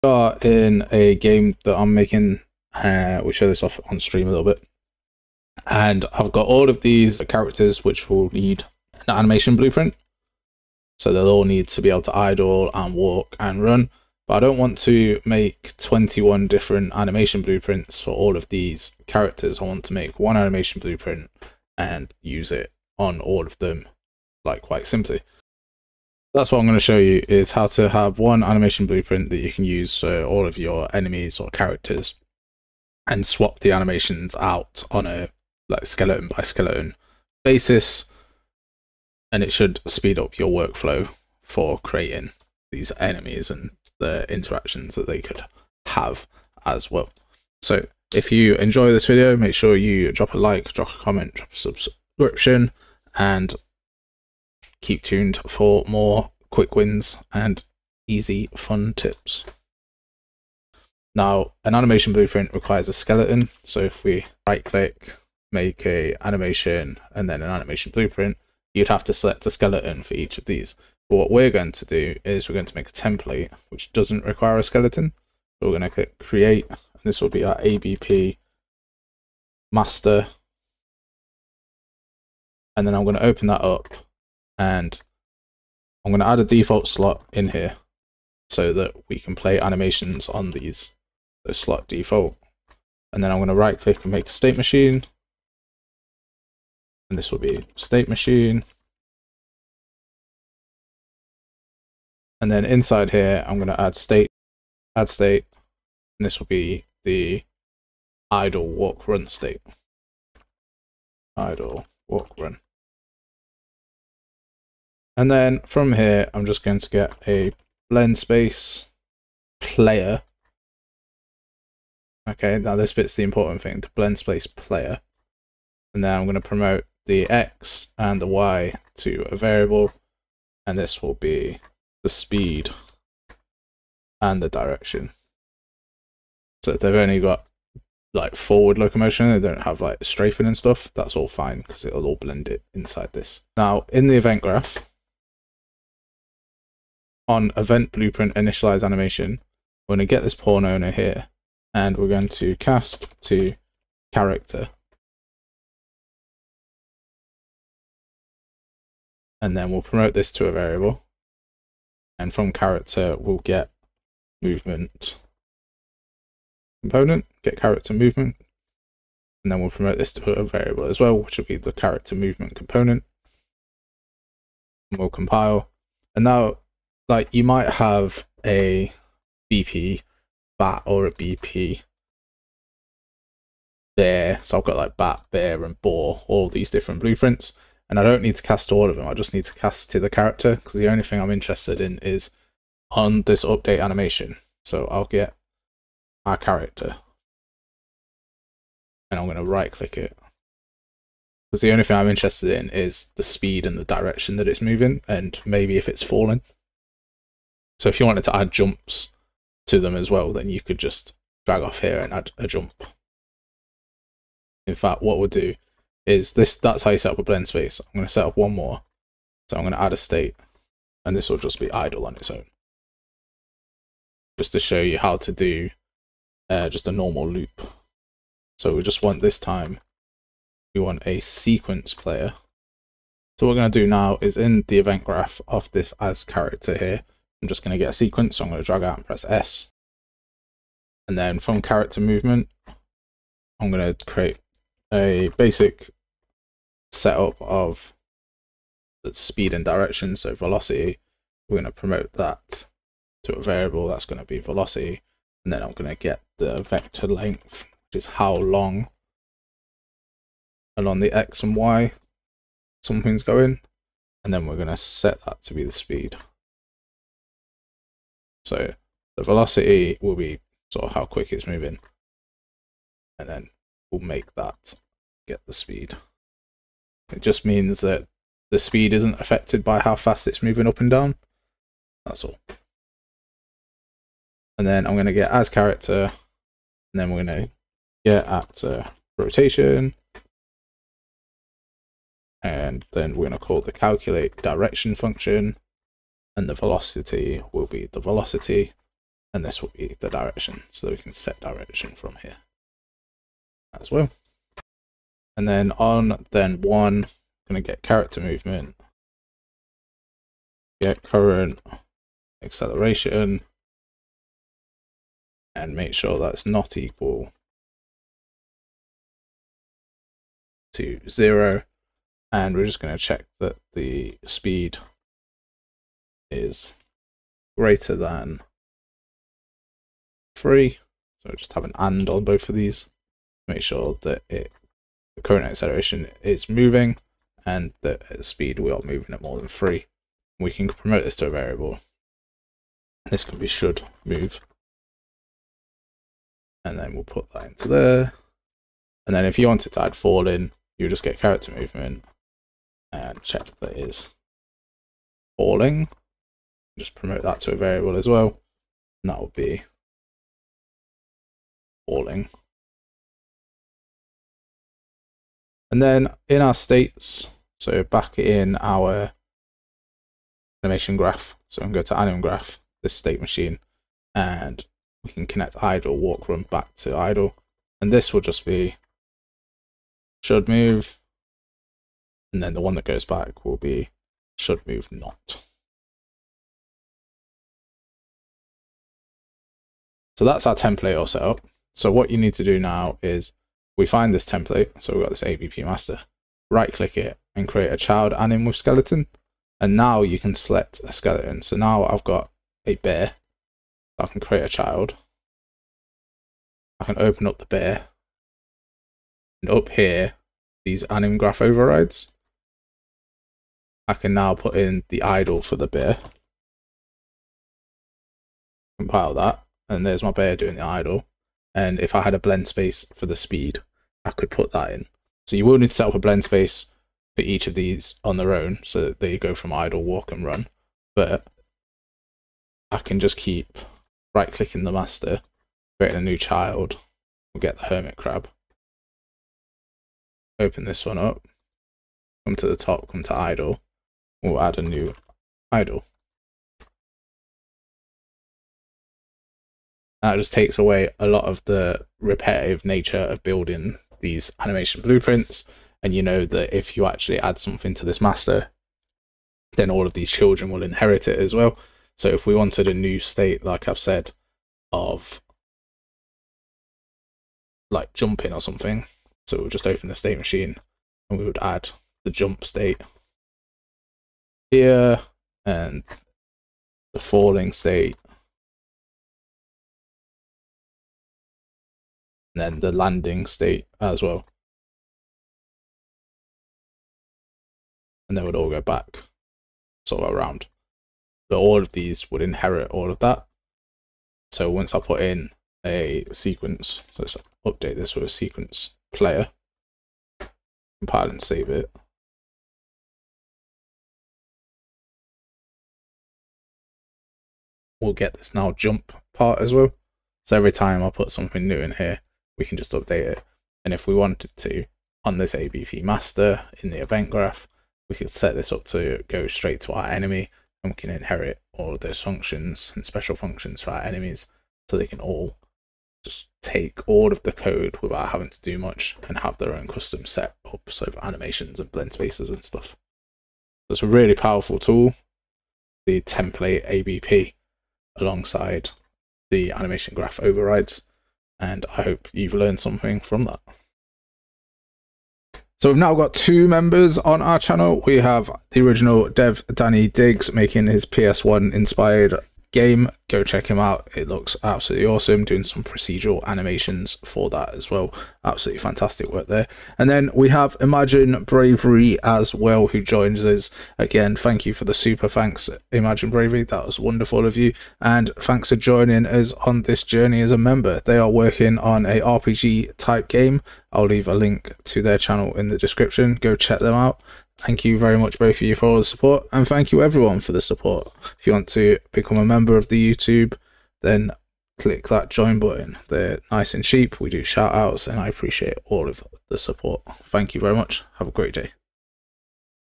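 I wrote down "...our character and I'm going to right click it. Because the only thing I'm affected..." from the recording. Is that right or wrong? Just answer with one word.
wrong.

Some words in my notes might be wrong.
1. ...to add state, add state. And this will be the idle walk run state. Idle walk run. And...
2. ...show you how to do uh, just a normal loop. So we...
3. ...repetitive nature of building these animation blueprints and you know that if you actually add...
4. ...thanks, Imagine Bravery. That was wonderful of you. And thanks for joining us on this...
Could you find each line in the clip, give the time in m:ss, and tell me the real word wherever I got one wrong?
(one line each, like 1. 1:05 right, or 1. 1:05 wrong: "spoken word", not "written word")
1. 1:43 right
2. 3:44 right
3. 7:31 right
4. 9:25 right.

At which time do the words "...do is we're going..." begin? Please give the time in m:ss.
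1:11.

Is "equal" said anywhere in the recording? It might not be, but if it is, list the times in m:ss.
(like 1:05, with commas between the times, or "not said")
5:16.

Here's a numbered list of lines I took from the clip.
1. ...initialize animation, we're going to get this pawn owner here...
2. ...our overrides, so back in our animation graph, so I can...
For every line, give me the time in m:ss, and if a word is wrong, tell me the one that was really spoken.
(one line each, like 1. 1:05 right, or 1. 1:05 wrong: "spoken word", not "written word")
1. 2:28 right
2. 6:06 wrong: "states", not "overrides".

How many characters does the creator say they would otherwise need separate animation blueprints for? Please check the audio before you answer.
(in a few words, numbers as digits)
21.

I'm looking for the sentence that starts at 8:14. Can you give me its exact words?
So once I put in a sequence, so let's update this with a sequence player, compile and save it.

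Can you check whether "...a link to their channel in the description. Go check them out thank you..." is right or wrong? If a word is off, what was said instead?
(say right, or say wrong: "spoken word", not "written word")
right.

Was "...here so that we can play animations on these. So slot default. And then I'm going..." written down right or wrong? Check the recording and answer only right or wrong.
right.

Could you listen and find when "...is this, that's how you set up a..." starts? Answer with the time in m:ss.
3:36.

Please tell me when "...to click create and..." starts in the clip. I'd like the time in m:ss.
1:15.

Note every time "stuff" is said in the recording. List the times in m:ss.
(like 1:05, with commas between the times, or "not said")
2:20, 8:52.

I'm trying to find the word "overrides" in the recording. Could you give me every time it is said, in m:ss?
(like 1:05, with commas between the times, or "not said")
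6:51, 9:00.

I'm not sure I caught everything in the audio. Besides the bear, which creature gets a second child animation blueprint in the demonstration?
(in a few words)
hermit crab.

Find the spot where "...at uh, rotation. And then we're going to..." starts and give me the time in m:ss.
4:48.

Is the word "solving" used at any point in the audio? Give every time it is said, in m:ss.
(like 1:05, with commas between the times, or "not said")
not said.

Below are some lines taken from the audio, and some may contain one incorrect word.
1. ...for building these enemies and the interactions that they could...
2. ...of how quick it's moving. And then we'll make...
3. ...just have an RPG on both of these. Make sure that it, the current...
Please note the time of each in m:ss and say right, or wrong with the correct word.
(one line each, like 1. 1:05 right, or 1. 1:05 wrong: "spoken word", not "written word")
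1. 0:41 wrong: "creating", not "building"
2. 4:30 right
3. 5:31 wrong: "AND", not "RPG".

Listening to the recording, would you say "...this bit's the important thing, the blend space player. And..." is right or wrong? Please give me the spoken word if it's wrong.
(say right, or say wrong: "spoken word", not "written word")
right.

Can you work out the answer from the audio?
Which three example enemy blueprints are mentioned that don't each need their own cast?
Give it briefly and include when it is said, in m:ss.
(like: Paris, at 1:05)
bat, bear and boar, at 3:04.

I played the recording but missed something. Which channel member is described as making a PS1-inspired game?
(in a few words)
Danny Diggs.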